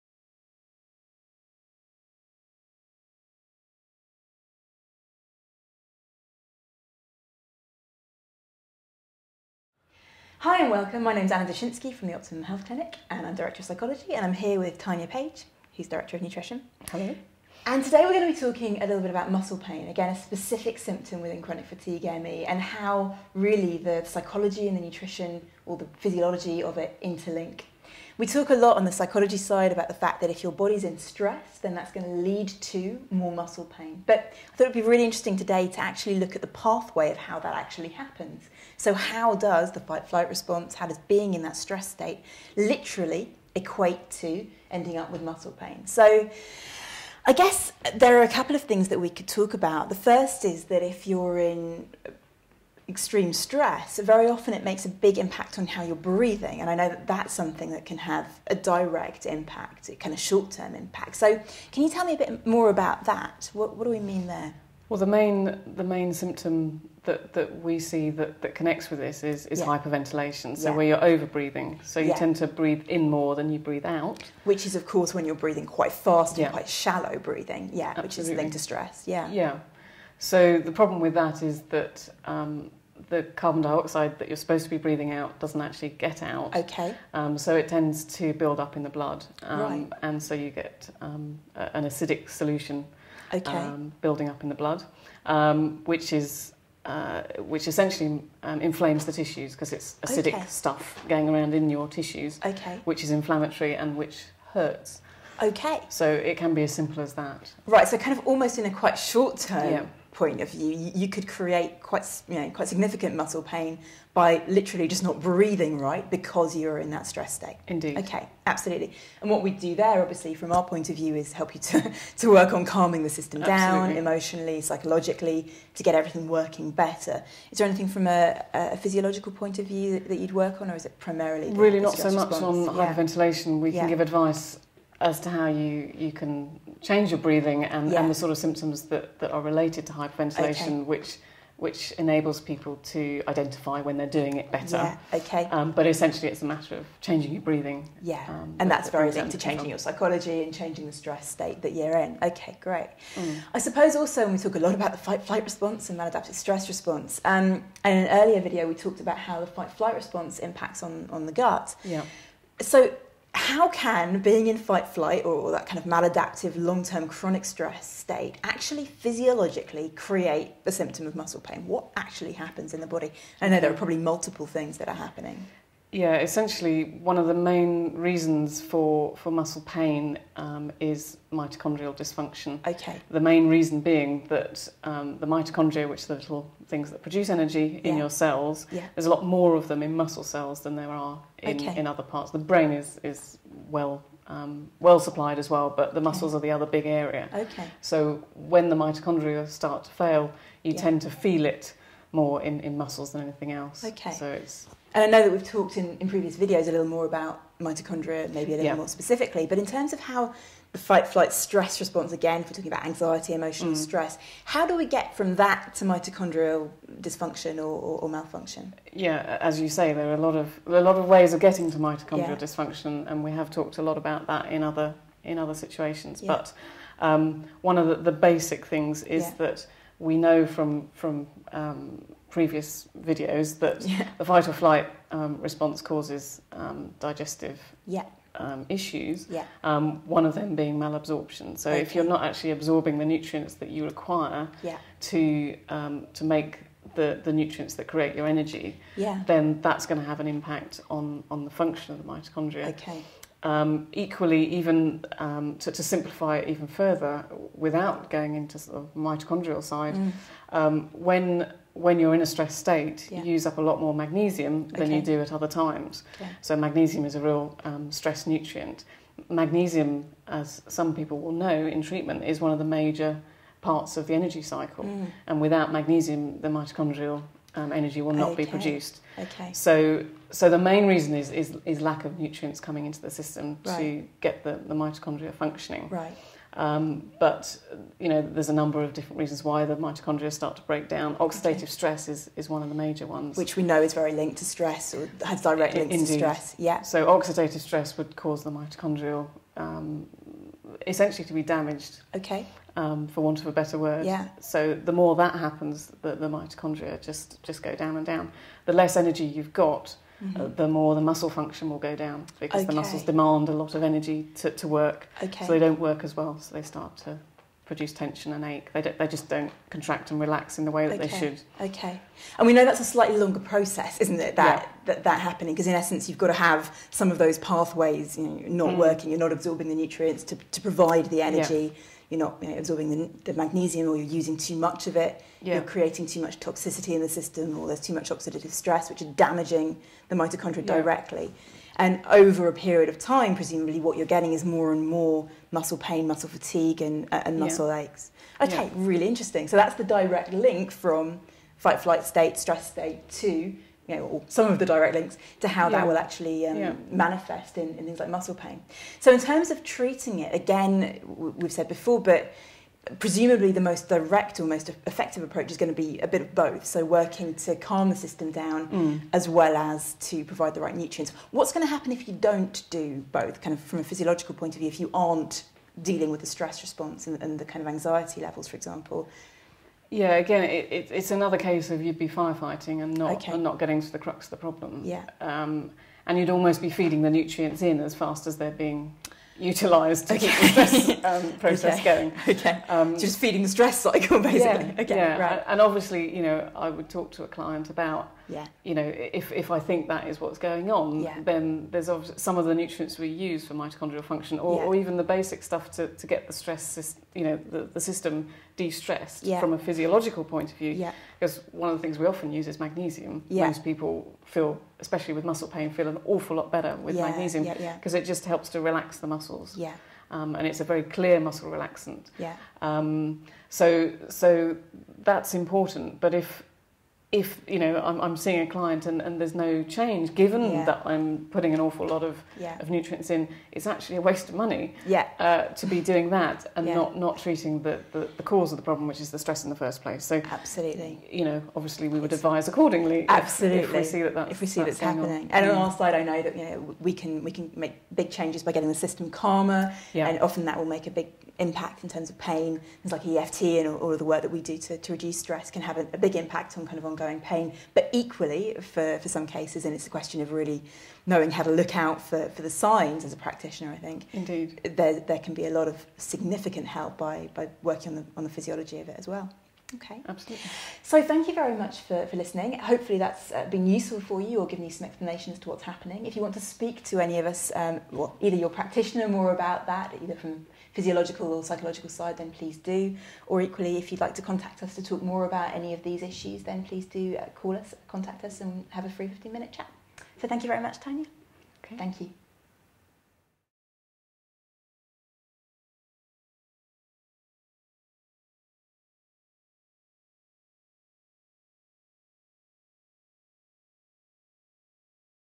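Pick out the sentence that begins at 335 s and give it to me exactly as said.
you're creating too much toxicity in the system or there's too much oxidative stress, which are damaging the mitochondria yeah.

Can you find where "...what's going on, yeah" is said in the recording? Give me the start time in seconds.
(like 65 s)
400 s.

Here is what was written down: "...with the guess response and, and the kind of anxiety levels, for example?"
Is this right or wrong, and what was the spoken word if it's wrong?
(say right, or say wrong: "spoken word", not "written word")
wrong: "stress", not "guess".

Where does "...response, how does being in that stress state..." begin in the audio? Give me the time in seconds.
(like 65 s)
40 s.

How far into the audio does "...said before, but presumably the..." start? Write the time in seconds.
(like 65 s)
361 s.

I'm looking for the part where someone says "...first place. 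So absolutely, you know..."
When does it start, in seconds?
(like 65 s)
439 s.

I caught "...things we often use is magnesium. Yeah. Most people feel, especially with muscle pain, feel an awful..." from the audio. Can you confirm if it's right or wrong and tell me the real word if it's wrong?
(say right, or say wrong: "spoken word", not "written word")
right.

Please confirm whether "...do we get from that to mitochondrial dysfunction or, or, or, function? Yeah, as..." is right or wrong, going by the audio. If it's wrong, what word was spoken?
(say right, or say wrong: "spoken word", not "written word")
wrong: "malfunction", not "function".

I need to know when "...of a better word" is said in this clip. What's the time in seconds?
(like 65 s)
303 s.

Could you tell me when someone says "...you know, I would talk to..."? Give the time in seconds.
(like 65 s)
396 s.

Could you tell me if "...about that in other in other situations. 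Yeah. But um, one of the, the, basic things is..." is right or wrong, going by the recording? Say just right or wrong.
right.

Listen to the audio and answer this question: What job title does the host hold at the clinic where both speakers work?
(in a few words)
Director of Psychology.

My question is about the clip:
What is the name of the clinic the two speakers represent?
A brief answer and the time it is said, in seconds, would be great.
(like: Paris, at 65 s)
Optimum Health Clinic, at 12 s.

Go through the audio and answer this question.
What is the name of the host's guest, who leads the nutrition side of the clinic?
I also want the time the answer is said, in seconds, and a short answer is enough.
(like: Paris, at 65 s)
Tanya Page, at 14 s.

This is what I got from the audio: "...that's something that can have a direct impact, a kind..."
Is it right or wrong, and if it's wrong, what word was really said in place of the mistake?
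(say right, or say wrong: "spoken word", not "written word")
right.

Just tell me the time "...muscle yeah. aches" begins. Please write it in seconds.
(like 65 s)
347 s.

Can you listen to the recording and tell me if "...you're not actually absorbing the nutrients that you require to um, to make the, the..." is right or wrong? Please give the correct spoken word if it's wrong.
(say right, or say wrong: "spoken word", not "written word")
right.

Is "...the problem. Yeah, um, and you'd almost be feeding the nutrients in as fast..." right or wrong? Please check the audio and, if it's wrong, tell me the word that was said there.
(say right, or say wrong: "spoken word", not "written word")
right.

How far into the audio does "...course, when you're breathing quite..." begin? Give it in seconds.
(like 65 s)
74 s.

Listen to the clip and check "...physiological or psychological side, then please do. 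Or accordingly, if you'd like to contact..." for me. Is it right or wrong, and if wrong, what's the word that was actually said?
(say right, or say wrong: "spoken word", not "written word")
wrong: "equally", not "accordingly".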